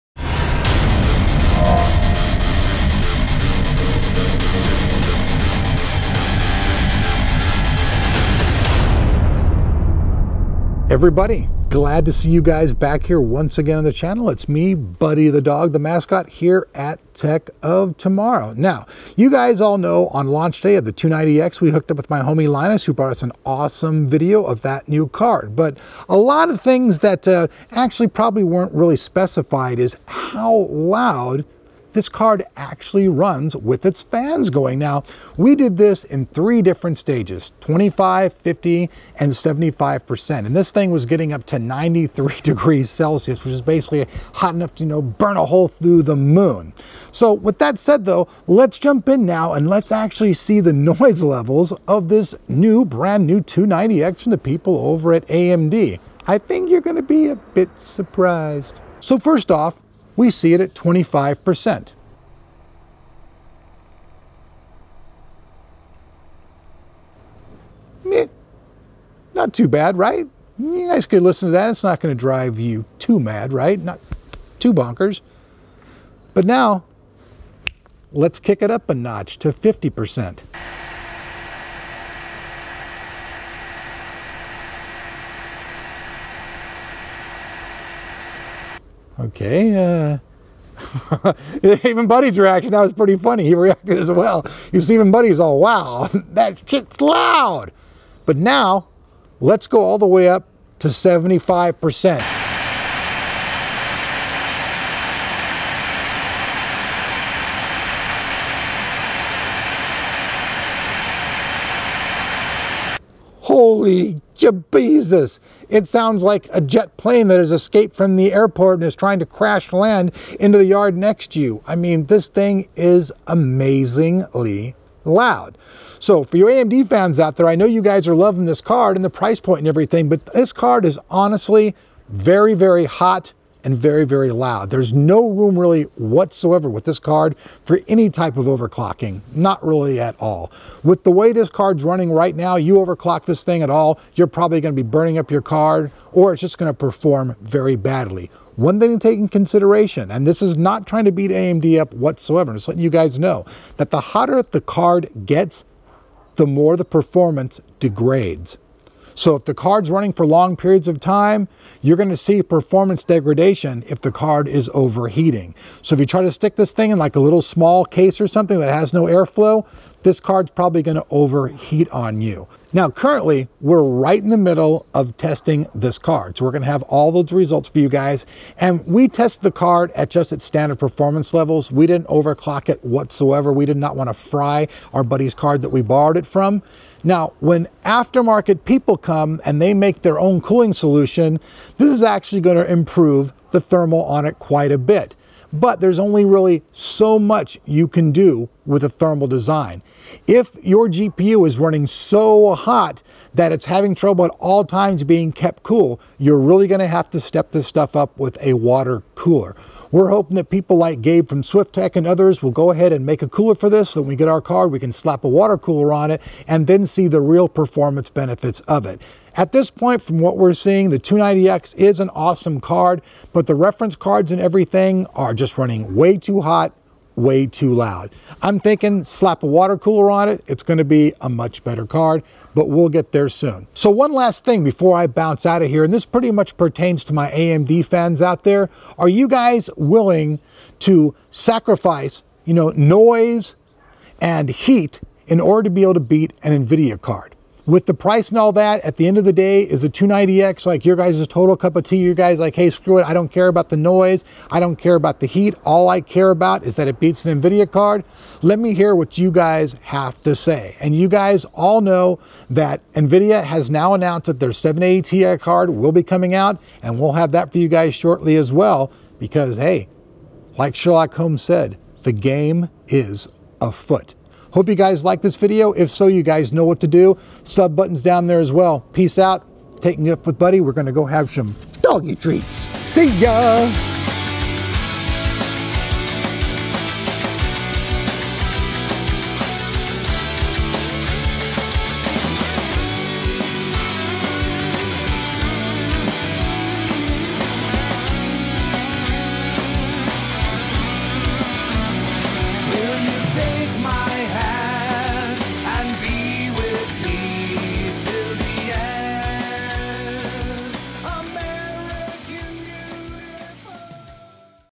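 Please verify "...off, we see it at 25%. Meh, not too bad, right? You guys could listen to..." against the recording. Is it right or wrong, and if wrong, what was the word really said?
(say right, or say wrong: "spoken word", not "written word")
right.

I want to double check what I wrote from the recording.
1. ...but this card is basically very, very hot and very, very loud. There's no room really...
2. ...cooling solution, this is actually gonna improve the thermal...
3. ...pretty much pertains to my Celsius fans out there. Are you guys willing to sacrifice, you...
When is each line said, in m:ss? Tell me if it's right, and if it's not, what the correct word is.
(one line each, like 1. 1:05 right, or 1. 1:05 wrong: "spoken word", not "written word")
1. 2:10 wrong: "honestly", not "basically"
2. 3:10 right
3. 3:56 wrong: "AMD", not "Celsius".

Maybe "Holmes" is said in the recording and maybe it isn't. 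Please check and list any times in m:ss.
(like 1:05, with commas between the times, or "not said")
4:31.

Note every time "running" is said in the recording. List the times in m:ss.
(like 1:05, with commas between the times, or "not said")
2:21, 2:39, 3:21, 3:45.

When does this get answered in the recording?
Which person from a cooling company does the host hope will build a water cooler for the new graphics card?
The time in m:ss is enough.
3:31.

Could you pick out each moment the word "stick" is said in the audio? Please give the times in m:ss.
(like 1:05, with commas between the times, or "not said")
2:46.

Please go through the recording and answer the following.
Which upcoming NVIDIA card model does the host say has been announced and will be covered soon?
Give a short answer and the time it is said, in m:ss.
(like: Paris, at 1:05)
780 Ti, at 4:24.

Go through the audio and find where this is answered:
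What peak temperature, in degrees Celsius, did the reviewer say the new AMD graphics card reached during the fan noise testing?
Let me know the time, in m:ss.
0:41.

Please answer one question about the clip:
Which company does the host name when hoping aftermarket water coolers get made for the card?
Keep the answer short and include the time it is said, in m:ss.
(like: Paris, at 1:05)
Swiftech, at 3:31.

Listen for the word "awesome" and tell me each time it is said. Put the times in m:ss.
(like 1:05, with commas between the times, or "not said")
0:23, 3:42.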